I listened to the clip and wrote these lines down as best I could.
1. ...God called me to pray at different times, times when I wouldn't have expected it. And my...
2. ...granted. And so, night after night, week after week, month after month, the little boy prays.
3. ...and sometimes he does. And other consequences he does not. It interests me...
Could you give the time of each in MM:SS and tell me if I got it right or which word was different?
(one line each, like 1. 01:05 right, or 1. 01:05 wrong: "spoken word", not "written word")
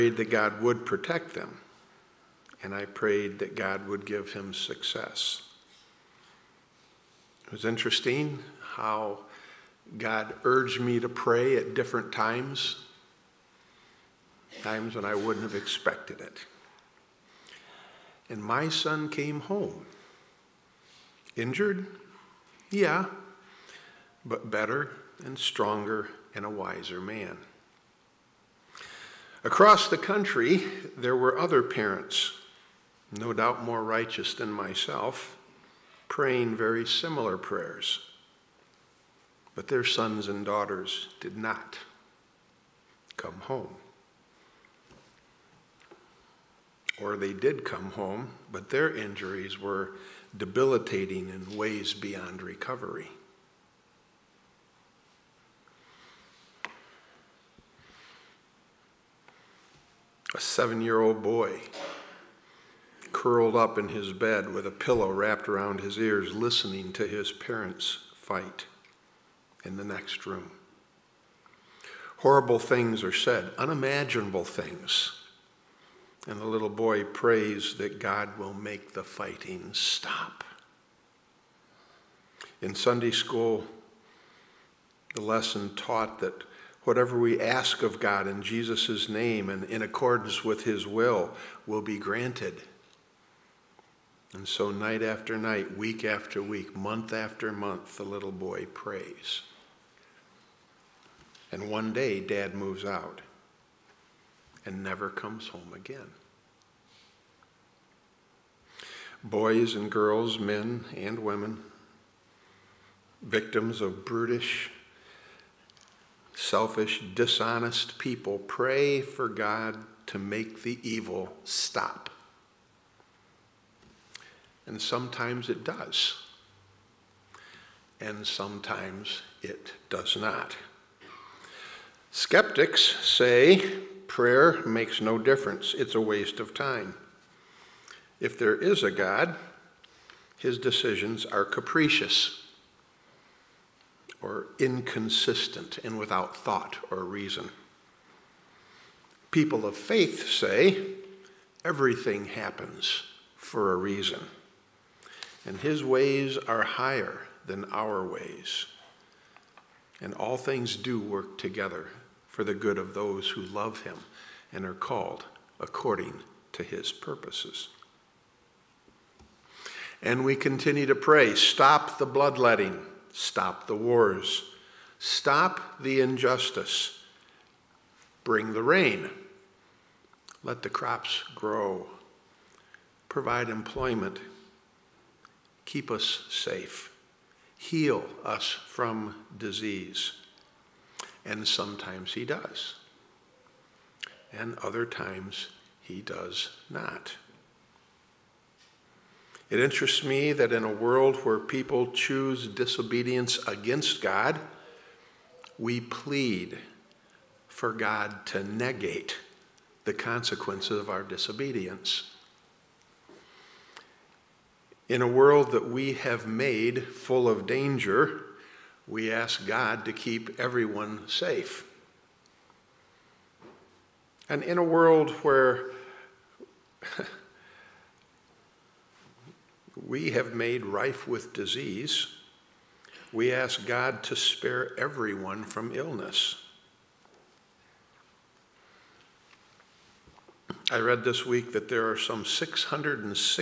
1. 00:09 wrong: "urged", not "called"
2. 01:31 right
3. 03:11 wrong: "times", not "consequences".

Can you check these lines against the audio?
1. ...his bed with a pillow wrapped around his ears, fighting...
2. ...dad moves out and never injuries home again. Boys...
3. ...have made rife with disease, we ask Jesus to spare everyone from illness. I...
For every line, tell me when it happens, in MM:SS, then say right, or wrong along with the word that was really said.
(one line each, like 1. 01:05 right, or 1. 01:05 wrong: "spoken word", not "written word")
1. 01:03 wrong: "listening", not "fighting"
2. 01:42 wrong: "comes", not "injuries"
3. 03:50 wrong: "God", not "Jesus".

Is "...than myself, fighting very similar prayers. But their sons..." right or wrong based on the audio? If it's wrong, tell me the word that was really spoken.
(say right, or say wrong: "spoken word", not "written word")
wrong: "praying", not "fighting".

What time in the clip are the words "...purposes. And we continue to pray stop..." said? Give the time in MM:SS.
02:46.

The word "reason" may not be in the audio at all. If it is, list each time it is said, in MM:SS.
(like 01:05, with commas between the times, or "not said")
02:27, 02:33.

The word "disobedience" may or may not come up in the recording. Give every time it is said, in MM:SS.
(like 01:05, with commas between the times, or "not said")
03:22, 03:31.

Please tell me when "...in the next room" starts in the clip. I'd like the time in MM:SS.
01:09.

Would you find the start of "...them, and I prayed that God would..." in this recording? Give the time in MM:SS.
00:01.